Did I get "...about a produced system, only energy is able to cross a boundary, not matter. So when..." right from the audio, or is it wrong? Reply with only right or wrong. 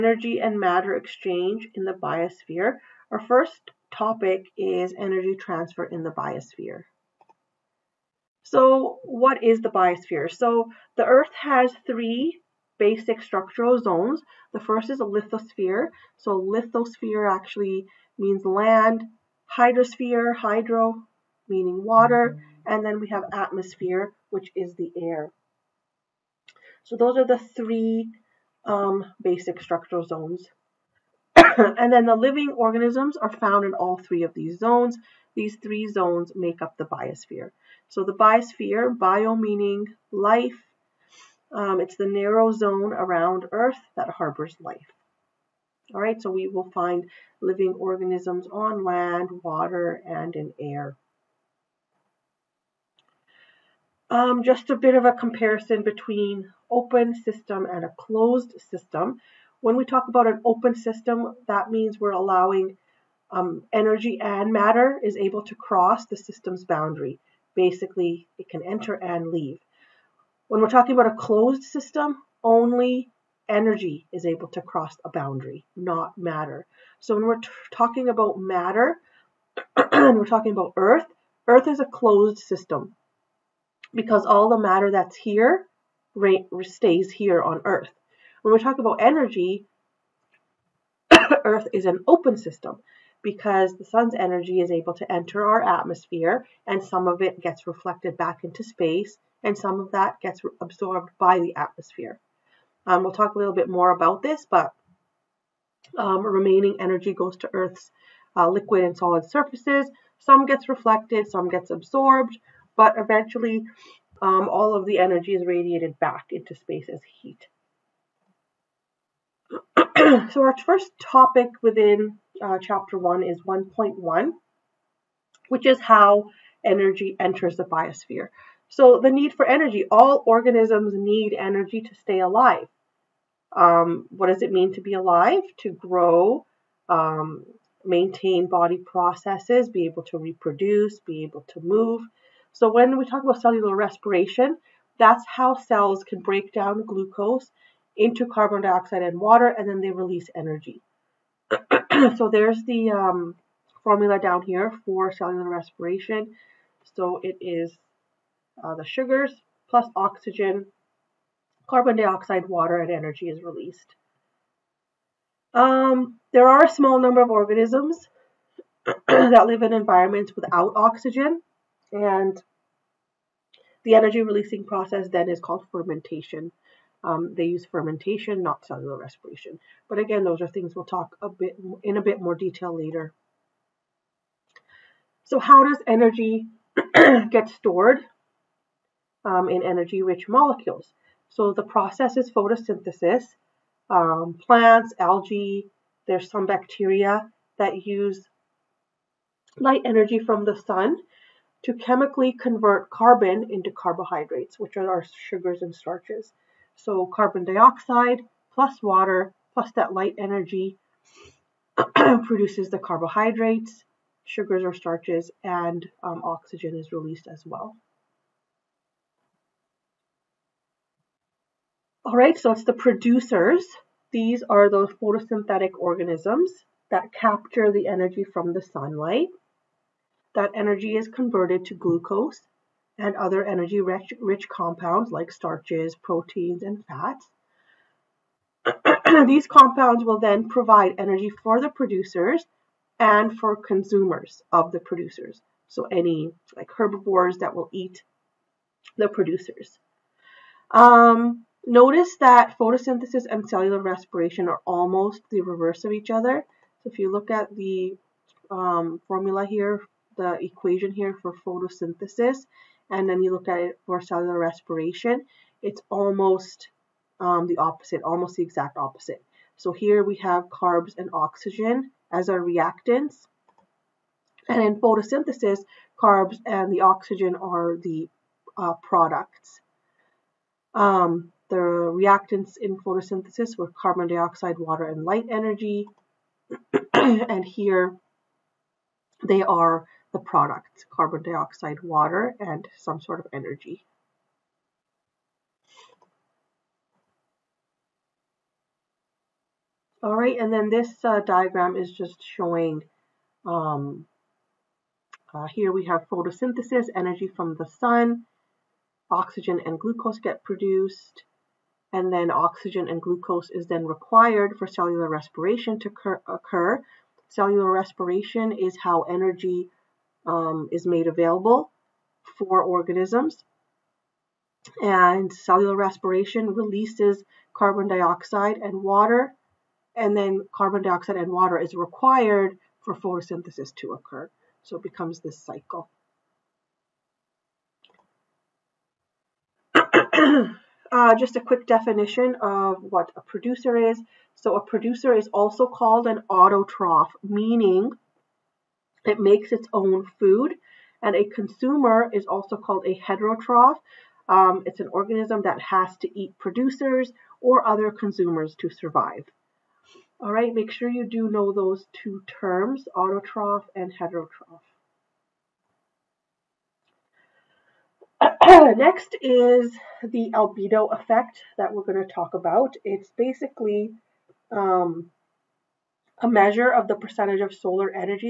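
wrong.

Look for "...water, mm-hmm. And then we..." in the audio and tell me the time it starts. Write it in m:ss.
0:21.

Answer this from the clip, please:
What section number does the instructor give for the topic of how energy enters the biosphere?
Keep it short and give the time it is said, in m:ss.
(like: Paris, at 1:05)
1.1, at 2:03.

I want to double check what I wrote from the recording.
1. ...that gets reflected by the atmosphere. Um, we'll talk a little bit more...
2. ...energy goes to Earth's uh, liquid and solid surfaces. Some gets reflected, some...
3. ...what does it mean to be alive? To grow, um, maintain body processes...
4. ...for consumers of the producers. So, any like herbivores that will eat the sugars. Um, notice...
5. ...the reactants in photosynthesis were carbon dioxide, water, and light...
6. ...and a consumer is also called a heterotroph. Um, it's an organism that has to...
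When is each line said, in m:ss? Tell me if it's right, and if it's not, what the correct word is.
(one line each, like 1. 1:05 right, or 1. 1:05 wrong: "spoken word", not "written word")
1. 1:39 wrong: "absorbed", not "reflected"
2. 1:46 right
3. 2:14 right
4. 4:03 wrong: "producers", not "sugars"
5. 4:41 right
6. 5:51 right.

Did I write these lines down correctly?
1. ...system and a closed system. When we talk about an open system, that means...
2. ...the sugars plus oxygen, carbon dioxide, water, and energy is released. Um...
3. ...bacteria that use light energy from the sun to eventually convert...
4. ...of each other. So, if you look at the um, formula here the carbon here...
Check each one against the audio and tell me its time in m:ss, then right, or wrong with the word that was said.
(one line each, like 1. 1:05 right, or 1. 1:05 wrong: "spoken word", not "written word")
1. 0:57 right
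2. 2:38 right
3. 3:16 wrong: "chemically", not "eventually"
4. 4:15 wrong: "equation", not "carbon".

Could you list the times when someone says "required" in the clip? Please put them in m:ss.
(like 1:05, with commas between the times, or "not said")
5:13, 5:31.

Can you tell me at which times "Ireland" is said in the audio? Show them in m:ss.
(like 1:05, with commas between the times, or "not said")
not said.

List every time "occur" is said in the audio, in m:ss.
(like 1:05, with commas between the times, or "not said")
5:16, 5:33.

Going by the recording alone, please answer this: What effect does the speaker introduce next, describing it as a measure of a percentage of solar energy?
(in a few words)
Albedo effect.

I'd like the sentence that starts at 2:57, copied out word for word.
Um, they use fermentation, not cellular respiration.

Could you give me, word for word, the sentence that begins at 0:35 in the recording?
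These three zones make up the biosphere.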